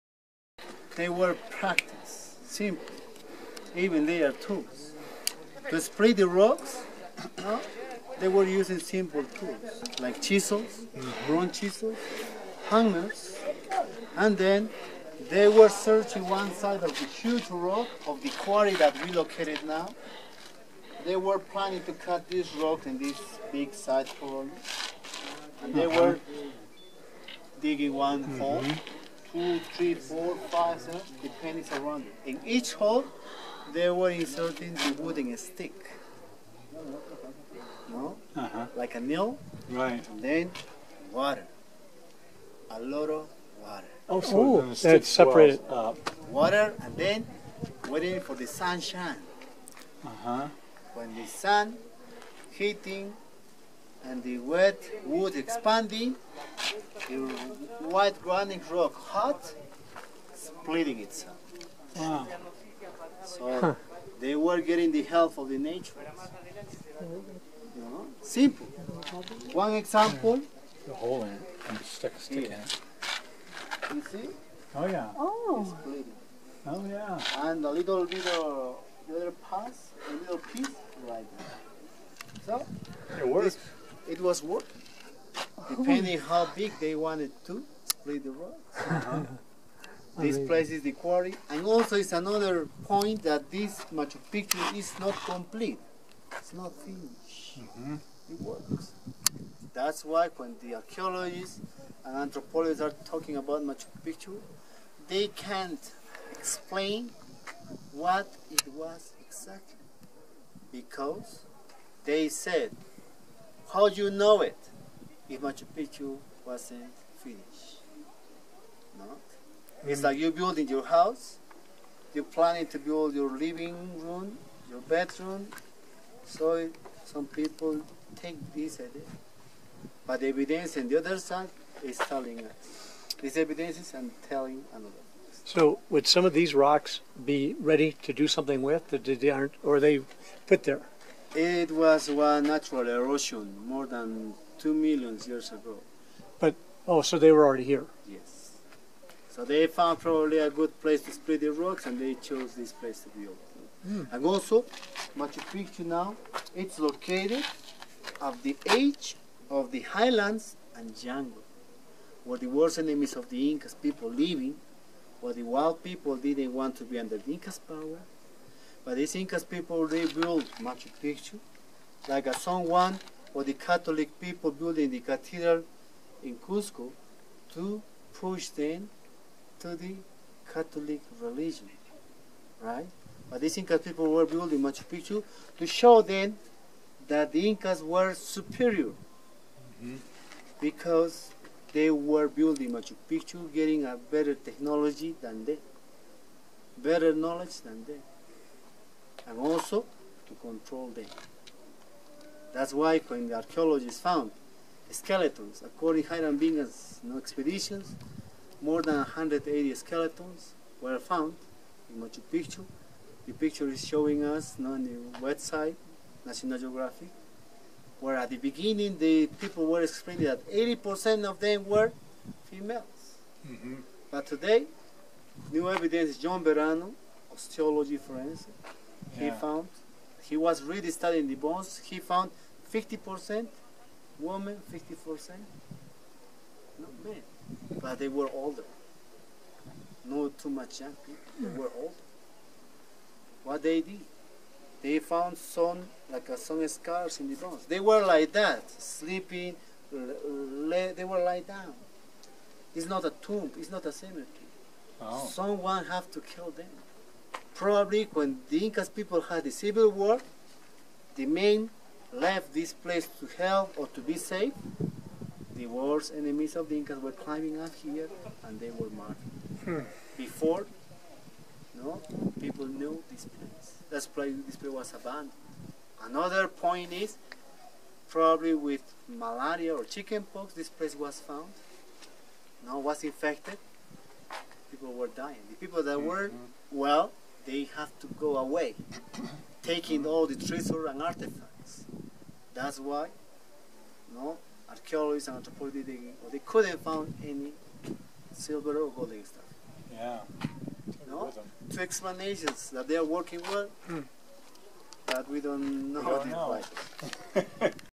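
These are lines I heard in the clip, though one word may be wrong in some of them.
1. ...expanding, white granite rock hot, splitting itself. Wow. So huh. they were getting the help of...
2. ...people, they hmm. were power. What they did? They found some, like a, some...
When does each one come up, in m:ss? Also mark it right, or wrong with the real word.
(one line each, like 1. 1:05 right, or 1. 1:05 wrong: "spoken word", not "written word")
1. 0:55 right
2. 4:01 wrong: "older", not "power".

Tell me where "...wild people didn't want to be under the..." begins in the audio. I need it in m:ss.
2:45.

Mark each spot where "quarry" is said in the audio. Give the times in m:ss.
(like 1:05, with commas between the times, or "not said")
0:18, 1:30.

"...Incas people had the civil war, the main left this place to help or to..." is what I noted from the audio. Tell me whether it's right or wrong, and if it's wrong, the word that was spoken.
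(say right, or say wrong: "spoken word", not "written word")
right.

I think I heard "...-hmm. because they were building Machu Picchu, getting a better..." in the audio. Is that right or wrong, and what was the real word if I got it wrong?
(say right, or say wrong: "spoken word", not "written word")
right.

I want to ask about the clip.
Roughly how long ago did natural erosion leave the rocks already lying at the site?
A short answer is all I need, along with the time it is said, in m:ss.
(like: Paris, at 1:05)
More than 2 million years ago, at 2:23.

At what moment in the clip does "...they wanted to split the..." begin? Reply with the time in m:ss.
1:26.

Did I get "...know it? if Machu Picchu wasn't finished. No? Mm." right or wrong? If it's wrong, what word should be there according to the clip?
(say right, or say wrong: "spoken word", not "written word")
right.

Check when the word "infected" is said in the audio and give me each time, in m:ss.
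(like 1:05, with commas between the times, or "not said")
4:43.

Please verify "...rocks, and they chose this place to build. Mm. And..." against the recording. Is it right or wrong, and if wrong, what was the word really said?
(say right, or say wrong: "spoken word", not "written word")
right.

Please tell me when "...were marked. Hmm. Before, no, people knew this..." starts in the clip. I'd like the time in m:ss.
4:28.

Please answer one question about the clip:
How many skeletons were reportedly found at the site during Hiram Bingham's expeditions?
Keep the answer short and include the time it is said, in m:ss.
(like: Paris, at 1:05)
More than 180, at 3:28.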